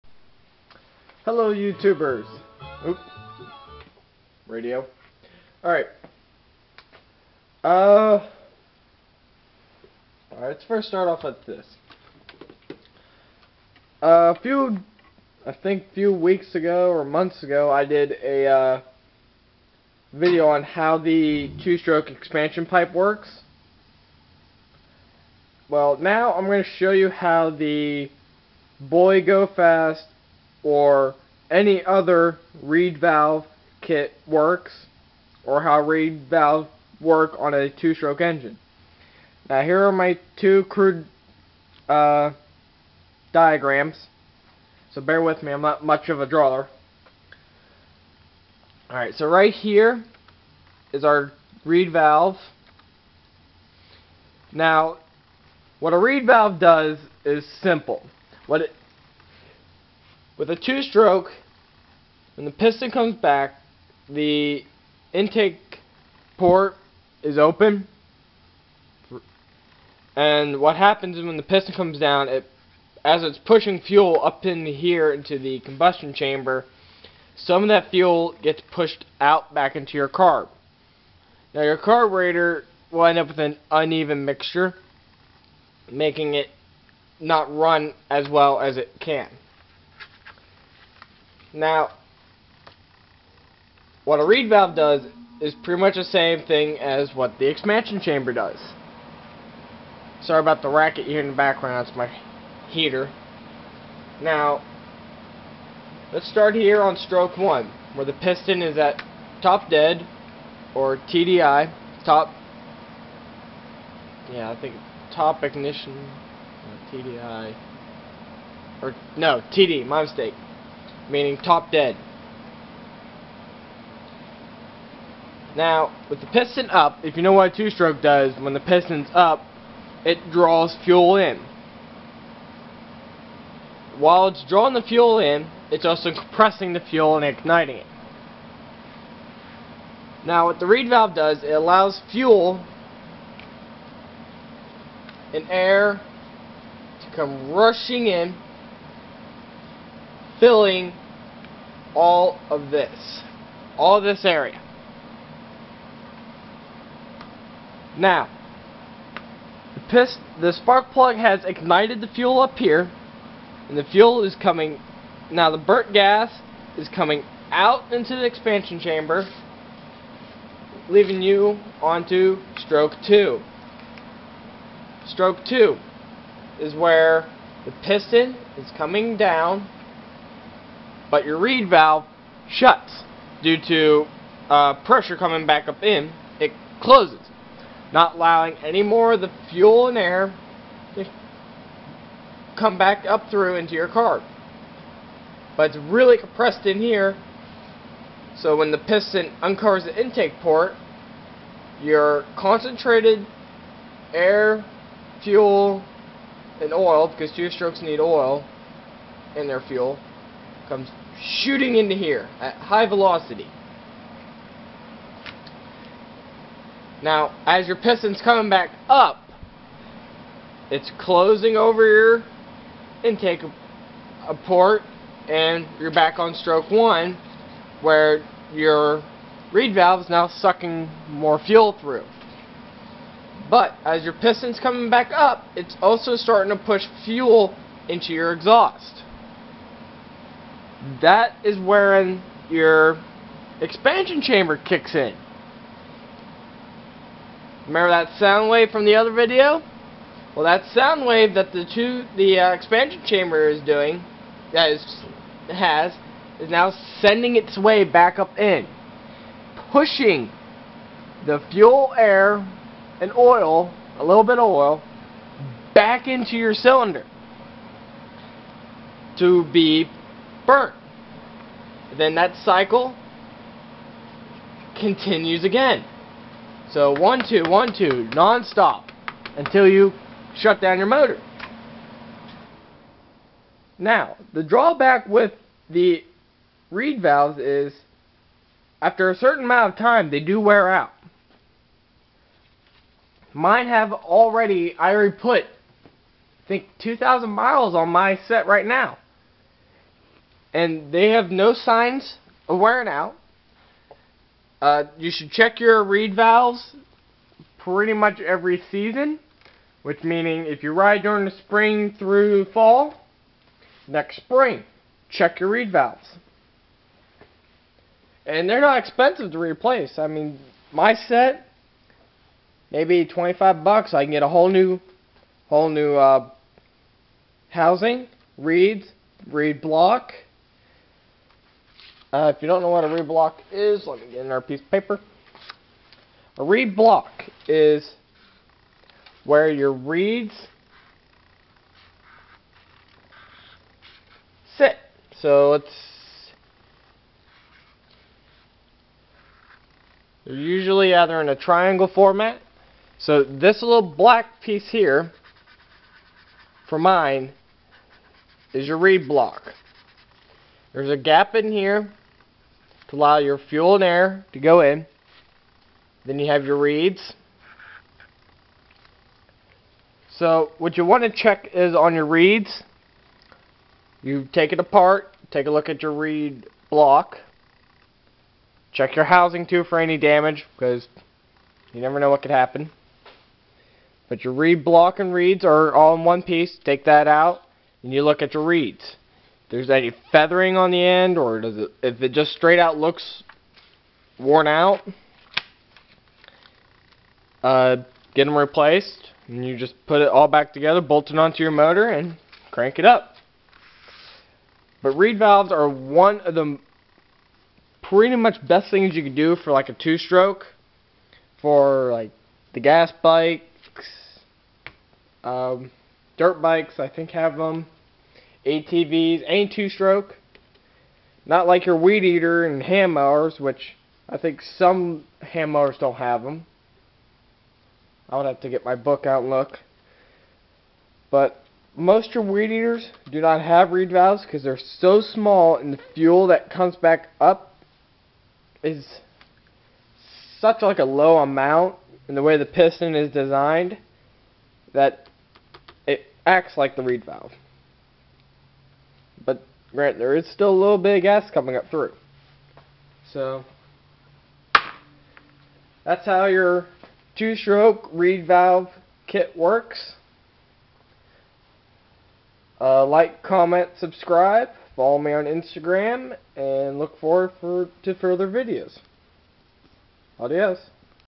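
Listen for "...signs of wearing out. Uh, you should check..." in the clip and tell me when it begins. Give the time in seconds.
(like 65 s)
301 s.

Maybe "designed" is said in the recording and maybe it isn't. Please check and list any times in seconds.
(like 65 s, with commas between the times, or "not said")
443 s.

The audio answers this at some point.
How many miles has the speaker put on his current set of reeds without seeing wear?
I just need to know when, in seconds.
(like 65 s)
296 s.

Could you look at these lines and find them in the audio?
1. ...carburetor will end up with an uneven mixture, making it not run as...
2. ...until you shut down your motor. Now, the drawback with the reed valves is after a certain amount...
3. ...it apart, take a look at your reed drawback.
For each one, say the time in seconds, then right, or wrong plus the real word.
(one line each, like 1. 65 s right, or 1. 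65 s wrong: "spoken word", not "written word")
1. 81 s right
2. 279 s right
3. 374 s wrong: "block", not "drawback".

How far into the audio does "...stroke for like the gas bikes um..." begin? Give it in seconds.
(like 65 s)
409 s.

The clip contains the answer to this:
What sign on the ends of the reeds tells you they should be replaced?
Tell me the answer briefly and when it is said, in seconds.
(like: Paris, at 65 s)
feathering, at 390 s.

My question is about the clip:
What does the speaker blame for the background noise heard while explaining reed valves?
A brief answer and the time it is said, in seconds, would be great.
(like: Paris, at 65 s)
heater, at 101 s.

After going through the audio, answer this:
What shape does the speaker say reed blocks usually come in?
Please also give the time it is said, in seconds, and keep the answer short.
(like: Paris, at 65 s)
triangle, at 351 s.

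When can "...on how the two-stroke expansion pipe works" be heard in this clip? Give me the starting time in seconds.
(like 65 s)
20 s.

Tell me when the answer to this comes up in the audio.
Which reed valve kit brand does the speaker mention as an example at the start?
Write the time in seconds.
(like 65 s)
28 s.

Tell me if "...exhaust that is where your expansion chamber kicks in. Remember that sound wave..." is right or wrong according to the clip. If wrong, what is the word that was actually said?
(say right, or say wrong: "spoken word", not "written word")
right.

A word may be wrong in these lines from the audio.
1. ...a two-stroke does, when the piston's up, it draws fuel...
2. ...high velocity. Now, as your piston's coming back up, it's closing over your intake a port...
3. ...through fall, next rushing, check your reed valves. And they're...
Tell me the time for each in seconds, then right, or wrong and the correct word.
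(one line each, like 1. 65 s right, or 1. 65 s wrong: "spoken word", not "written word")
1. 127 s right
2. 212 s right
3. 311 s wrong: "spring", not "rushing".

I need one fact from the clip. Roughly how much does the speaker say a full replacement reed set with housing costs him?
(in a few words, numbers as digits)
$25.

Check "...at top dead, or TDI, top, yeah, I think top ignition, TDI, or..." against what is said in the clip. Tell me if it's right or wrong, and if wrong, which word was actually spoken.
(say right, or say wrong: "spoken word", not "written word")
right.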